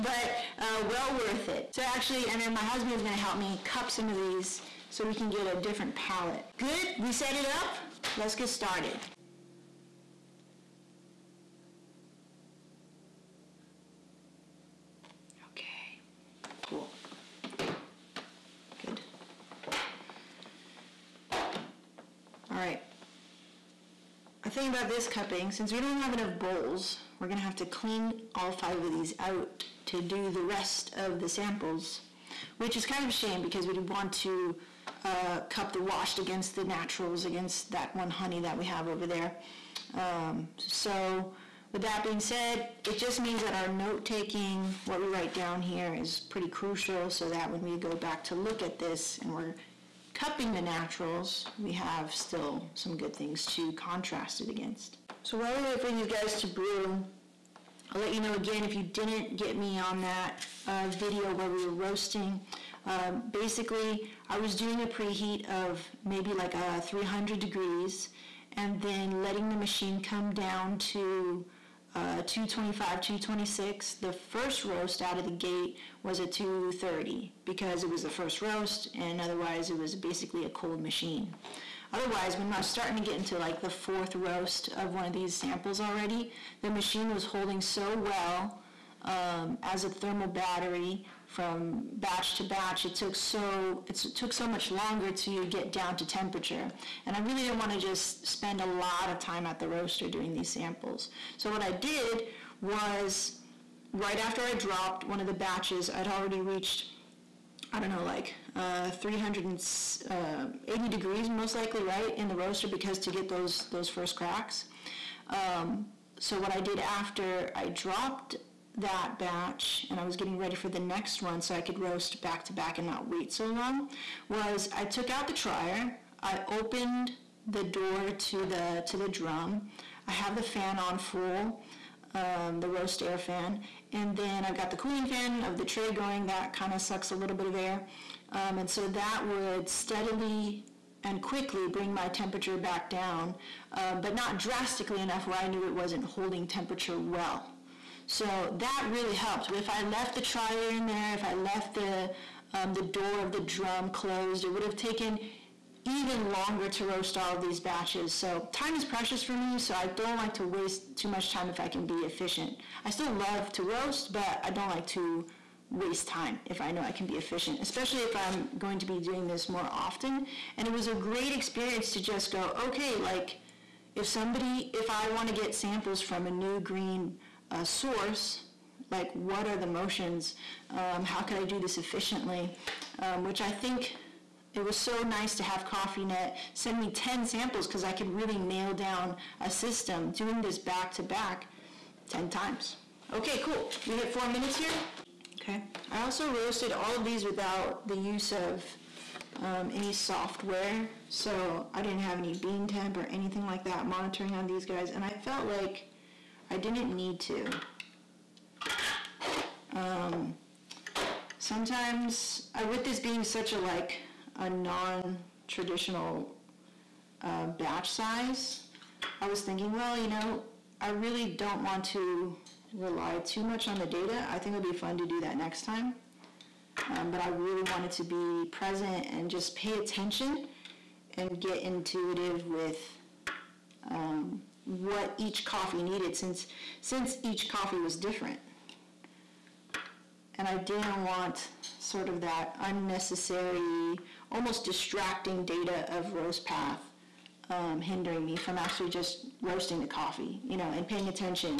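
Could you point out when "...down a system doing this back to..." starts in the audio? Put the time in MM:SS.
03:08.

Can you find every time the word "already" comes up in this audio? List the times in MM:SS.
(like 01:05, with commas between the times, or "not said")
01:25, 01:46.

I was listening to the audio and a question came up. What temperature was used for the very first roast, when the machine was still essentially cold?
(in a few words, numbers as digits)
230.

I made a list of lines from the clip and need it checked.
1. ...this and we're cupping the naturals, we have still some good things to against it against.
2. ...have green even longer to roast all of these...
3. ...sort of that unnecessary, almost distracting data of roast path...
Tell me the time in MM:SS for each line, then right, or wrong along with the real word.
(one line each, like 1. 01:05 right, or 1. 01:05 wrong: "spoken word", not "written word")
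1. 00:48 wrong: "contrast", not "against"
2. 02:34 wrong: "taken", not "green"
3. 04:01 right.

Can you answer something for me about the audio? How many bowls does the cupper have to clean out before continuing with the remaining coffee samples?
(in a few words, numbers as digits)
5.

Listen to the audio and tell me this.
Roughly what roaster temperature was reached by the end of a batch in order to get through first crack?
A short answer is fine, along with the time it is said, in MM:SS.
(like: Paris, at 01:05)
380 degrees, at 01:48.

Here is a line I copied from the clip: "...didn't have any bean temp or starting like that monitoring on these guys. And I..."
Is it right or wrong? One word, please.
wrong.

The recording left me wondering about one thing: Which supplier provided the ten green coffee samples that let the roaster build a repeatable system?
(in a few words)
Cofinet.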